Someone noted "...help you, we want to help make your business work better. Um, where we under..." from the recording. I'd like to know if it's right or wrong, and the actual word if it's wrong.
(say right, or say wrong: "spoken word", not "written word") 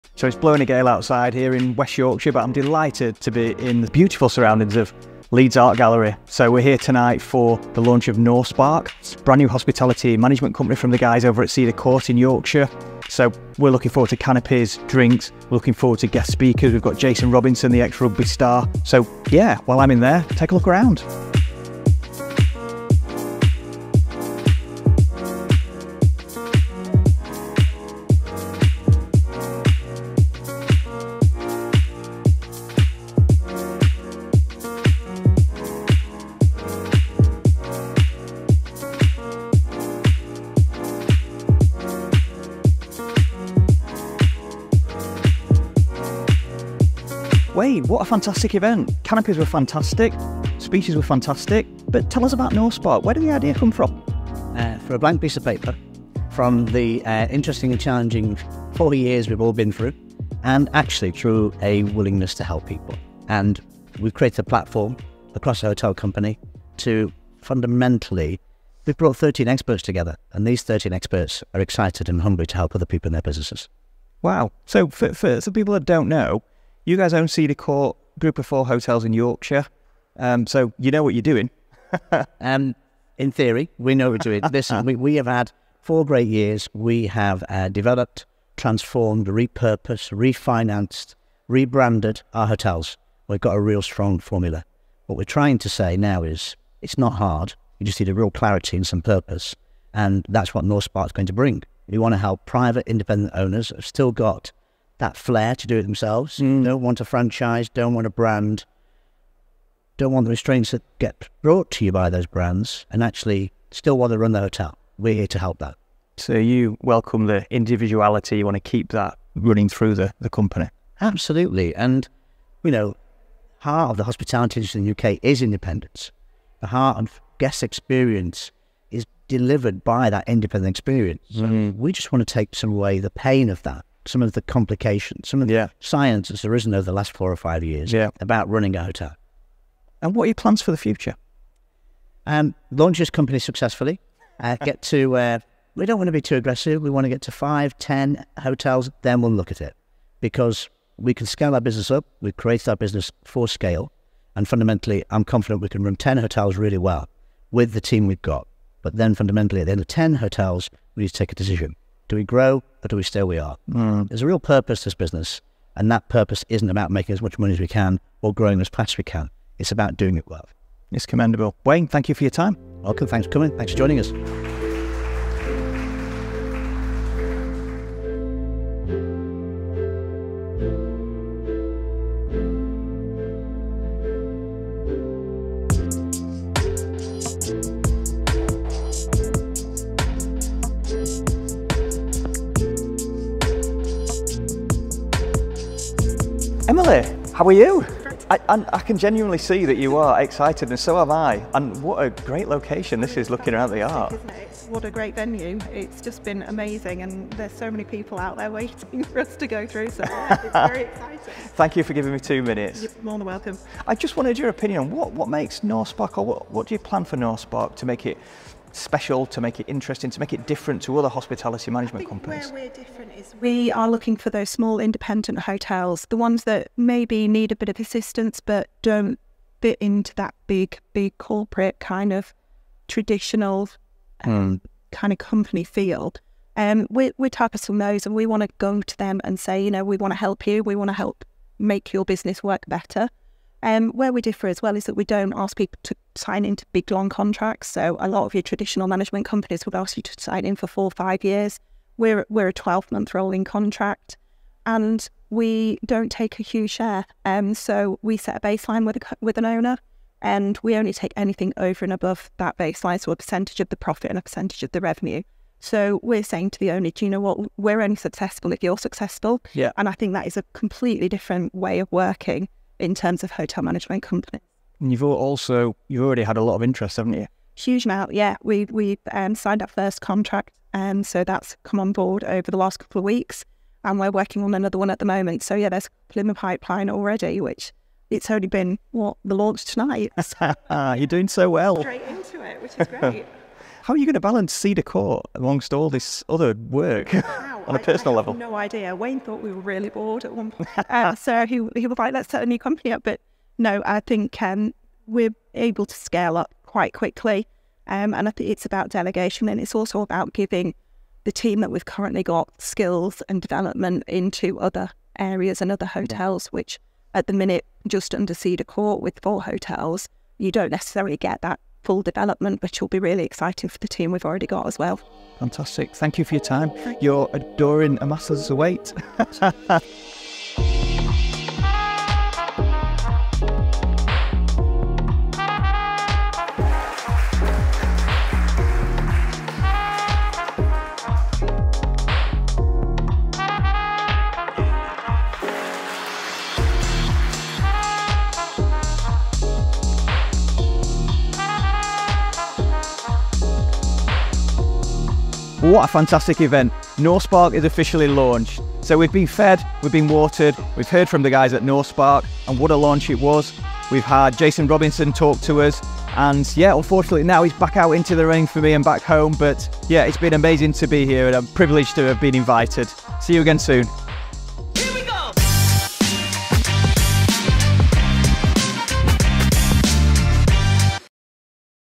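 wrong: "differ", not "under".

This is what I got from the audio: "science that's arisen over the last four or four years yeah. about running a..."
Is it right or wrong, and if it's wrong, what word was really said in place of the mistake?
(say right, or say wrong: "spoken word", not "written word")
wrong: "five", not "four".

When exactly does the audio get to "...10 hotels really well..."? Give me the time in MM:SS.
02:35.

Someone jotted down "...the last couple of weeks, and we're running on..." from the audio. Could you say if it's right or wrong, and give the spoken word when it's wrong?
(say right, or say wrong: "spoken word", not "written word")
wrong: "working", not "running".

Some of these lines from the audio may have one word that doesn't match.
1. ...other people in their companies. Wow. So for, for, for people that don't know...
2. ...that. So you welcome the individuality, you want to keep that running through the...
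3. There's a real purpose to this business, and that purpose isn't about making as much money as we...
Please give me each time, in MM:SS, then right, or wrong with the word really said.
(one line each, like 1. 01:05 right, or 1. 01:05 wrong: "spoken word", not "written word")
1. 01:12 wrong: "businesses", not "companies"
2. 01:55 right
3. 02:44 right.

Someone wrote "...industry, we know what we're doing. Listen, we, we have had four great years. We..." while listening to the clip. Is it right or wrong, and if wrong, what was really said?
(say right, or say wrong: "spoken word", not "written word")
wrong: "theory", not "industry".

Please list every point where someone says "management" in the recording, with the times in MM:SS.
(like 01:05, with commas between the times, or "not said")
00:10, 03:41, 04:08, 04:33.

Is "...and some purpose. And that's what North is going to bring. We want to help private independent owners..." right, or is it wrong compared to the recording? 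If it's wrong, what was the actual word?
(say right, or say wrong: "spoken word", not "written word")
right.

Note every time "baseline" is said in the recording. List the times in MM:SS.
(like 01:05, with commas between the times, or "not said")
04:18, 04:22.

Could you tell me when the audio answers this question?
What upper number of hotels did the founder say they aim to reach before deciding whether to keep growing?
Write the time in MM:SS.
02:27.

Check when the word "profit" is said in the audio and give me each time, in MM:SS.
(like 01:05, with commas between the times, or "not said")
04:23.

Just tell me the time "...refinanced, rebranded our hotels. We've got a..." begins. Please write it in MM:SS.
01:30.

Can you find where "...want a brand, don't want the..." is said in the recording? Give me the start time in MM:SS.
01:47.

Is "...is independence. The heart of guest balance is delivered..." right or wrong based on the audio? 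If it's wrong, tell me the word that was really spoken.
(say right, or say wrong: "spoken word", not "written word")
wrong: "experience", not "balance".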